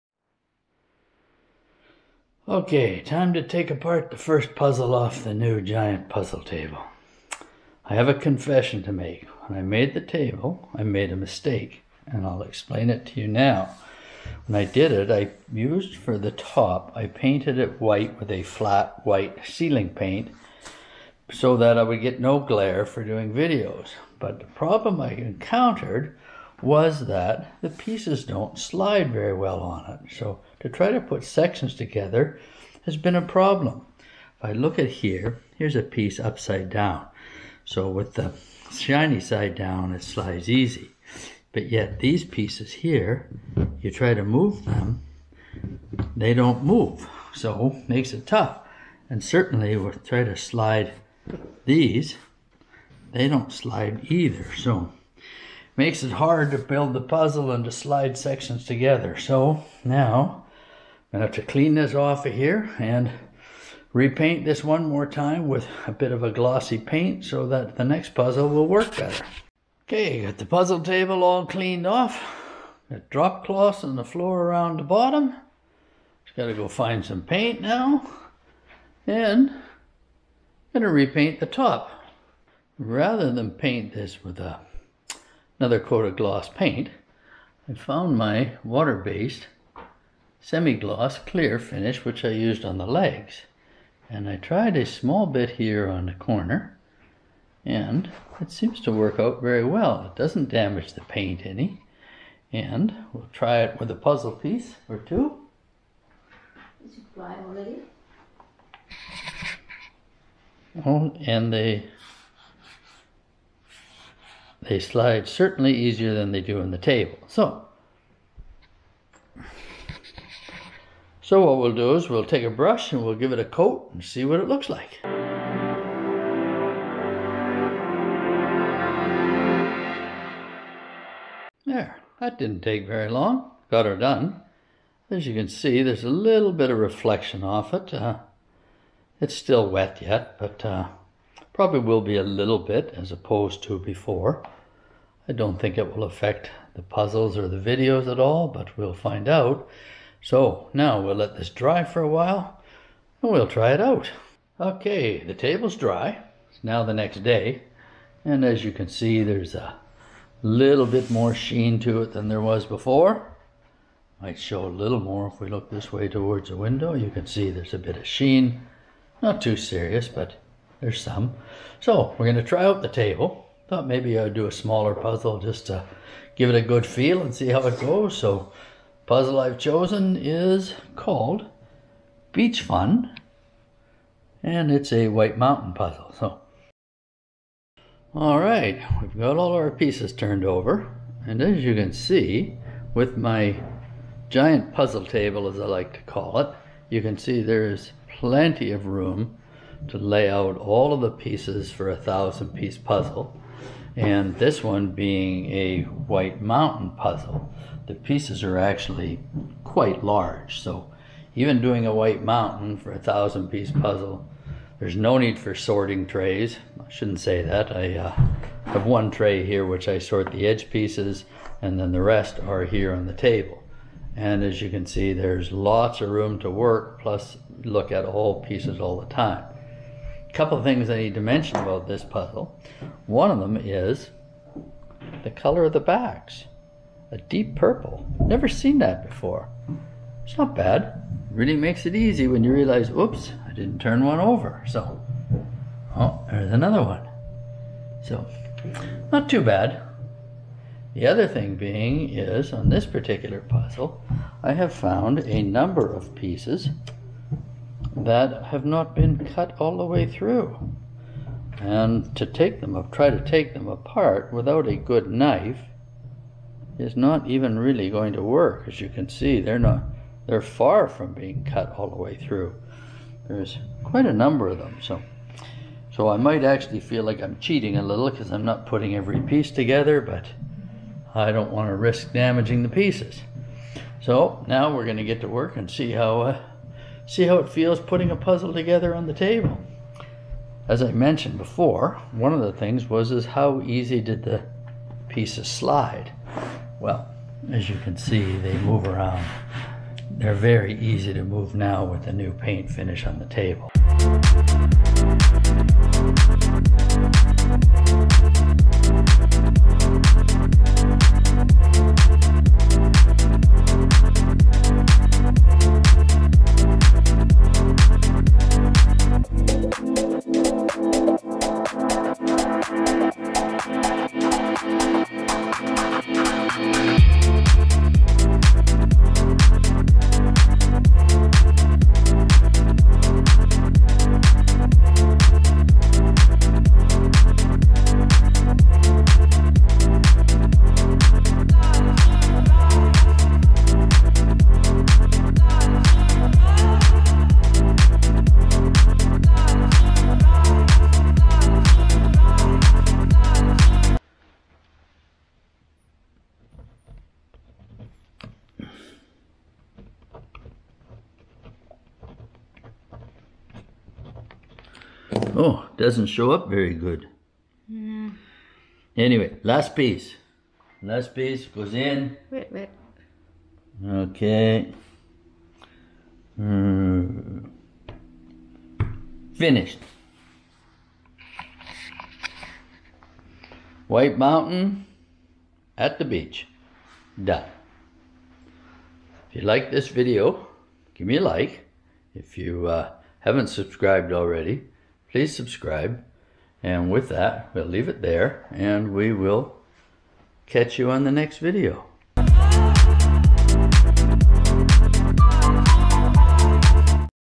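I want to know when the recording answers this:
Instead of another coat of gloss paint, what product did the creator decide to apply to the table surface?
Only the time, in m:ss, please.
1:28.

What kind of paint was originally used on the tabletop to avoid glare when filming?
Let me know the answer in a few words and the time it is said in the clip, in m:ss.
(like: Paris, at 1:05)
Flat white ceiling paint, at 0:18.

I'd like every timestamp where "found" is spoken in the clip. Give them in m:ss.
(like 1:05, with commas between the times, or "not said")
1:27, 4:14.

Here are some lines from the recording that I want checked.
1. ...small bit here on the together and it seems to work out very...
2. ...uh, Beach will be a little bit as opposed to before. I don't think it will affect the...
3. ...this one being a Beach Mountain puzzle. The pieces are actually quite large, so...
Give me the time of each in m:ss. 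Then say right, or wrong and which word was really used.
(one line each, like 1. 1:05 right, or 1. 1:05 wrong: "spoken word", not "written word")
1. 1:34 wrong: "corner", not "together"
2. 2:20 wrong: "Probably", not "Beach"
3. 3:24 wrong: "White", not "Beach".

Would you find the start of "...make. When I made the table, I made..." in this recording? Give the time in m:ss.
0:08.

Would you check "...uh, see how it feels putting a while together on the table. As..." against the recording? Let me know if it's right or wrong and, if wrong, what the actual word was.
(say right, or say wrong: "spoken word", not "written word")
wrong: "puzzle", not "while".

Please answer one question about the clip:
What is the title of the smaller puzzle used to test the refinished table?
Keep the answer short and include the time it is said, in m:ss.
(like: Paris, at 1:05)
Beach Fun, at 3:02.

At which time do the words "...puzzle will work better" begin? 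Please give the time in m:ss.
1:08.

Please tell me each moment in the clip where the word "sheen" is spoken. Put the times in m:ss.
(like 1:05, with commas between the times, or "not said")
2:41, 2:48.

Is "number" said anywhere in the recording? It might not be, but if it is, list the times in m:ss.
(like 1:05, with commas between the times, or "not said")
4:15, 4:34.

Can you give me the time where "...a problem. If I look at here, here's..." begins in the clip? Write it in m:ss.
0:33.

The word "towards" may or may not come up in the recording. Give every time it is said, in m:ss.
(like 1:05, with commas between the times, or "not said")
2:46.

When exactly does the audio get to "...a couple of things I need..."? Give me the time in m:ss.
3:50.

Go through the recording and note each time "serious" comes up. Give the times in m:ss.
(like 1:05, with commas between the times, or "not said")
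2:49.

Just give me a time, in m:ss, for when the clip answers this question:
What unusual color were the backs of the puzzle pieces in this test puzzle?
3:57.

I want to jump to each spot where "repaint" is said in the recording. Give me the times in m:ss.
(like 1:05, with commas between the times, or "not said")
1:03, 1:20.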